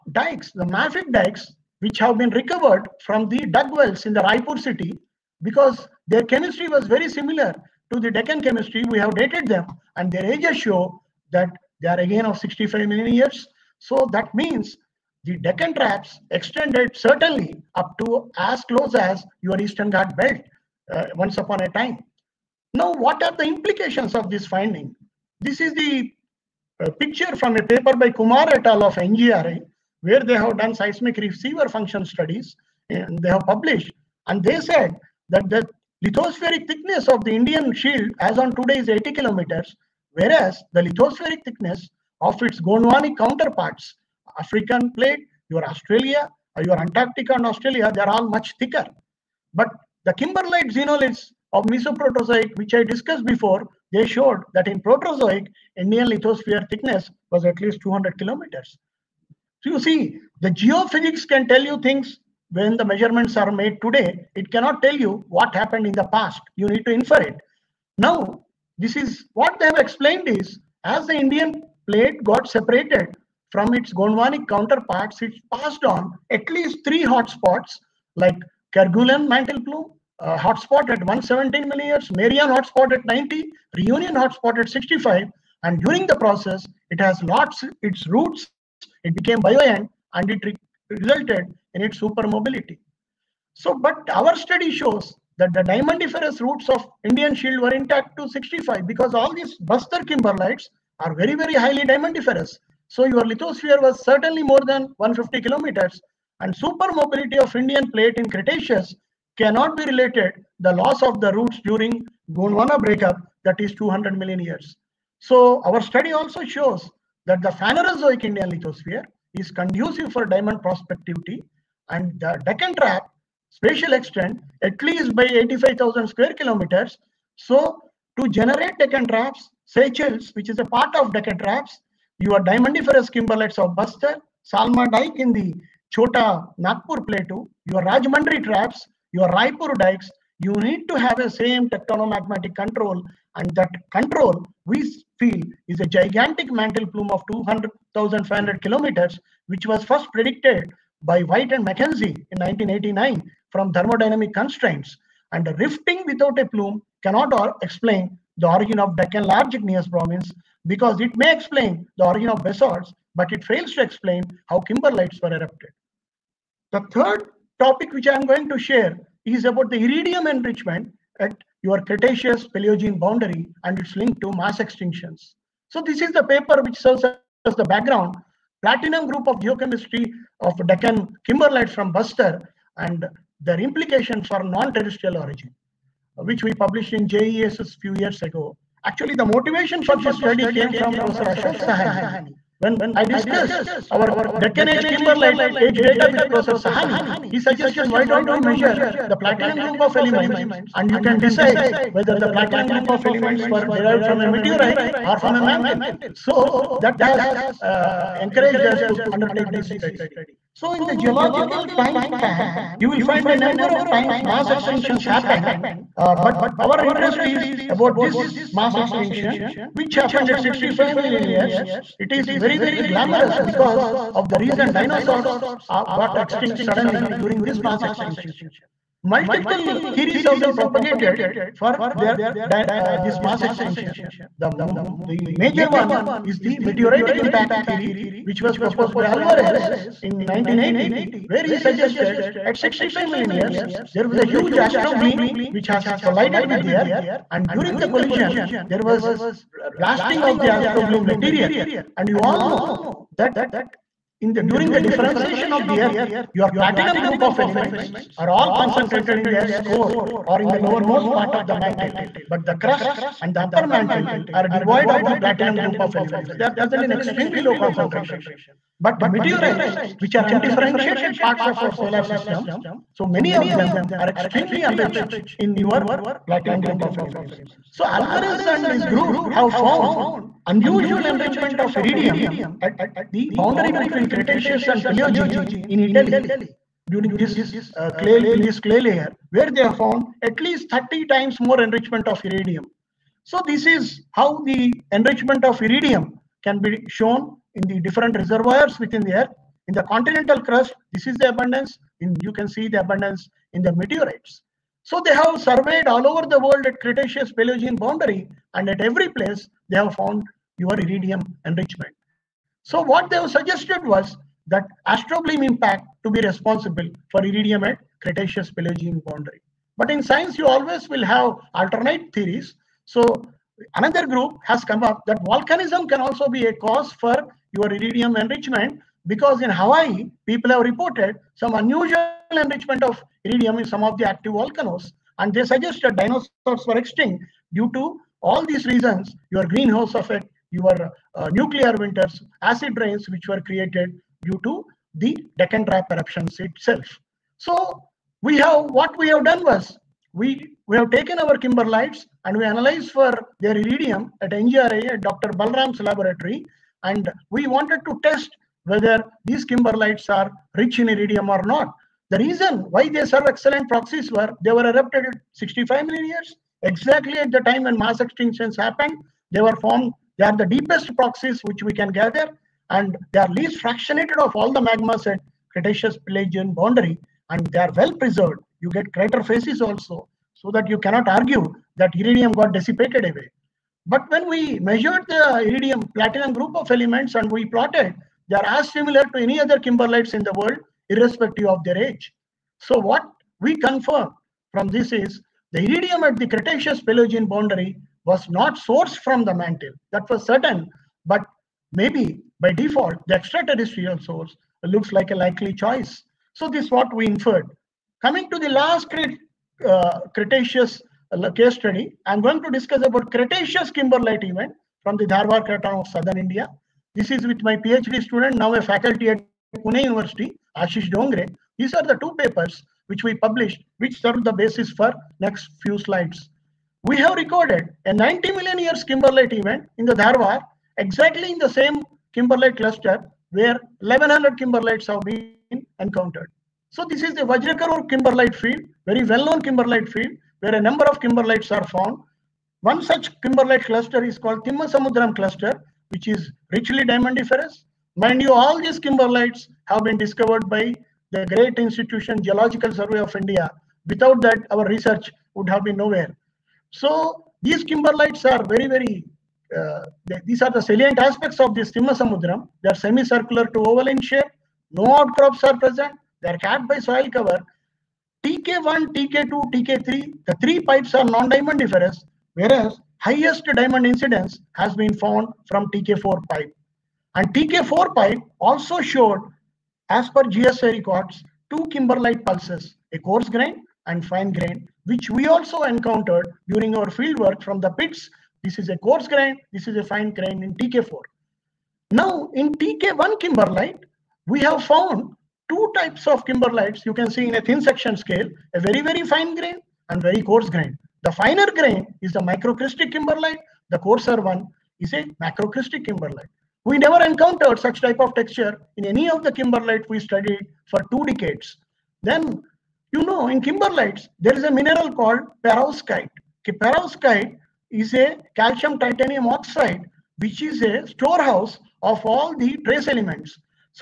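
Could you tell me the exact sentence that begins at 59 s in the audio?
So you see, the geophysics can tell you things when the measurements are made today.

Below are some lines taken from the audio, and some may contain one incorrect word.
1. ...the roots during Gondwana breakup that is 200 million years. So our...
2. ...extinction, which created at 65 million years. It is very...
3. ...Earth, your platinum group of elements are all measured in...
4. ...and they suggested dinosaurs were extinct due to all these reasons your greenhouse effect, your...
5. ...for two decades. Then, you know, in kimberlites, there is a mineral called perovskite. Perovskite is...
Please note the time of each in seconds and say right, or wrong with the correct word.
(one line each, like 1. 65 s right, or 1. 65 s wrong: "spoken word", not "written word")
1. 111 s right
2. 218 s wrong: "happened", not "created"
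3. 255 s wrong: "concentrated", not "measured"
4. 335 s right
5. 510 s right.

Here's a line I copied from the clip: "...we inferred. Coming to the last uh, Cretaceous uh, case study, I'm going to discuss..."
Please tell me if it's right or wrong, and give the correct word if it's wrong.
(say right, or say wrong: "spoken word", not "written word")
right.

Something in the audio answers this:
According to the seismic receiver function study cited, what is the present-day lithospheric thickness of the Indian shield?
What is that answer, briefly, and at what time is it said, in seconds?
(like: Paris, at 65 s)
80 kilometers, at 38 s.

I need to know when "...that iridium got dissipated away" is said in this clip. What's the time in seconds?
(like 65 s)
381 s.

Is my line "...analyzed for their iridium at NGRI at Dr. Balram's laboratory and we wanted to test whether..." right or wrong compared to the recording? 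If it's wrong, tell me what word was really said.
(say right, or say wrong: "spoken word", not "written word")
right.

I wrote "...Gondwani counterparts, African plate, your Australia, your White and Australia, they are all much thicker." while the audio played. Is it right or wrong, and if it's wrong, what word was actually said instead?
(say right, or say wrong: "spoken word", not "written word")
wrong: "Antarctica", not "White".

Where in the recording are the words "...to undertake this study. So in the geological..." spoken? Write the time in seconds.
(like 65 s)
208 s.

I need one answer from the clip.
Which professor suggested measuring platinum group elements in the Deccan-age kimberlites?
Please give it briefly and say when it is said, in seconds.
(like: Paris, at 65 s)
Ashok Sahni, at 191 s.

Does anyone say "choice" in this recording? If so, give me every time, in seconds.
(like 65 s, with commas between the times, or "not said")
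405 s.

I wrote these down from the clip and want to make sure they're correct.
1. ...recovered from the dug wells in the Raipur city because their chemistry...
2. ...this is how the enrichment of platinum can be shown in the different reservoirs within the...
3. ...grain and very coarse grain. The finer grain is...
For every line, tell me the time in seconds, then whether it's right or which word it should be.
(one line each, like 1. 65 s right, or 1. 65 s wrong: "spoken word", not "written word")
1. 2 s right
2. 293 s wrong: "iridium", not "platinum"
3. 499 s right.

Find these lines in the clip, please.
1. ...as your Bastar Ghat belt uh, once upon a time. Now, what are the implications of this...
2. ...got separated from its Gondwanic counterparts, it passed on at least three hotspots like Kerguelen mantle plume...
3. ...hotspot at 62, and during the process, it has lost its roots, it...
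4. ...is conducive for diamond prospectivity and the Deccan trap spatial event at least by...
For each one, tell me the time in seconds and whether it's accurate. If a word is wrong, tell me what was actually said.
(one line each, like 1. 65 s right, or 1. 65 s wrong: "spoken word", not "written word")
1. 18 s wrong: "Eastern", not "Bastar"
2. 72 s right
3. 84 s wrong: "65", not "62"
4. 119 s wrong: "extent", not "event".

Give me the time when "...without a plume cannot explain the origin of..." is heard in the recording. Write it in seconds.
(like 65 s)
156 s.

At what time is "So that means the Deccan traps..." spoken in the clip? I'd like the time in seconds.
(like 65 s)
13 s.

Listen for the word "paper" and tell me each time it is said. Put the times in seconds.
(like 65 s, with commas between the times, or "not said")
27 s, 176 s, 422 s.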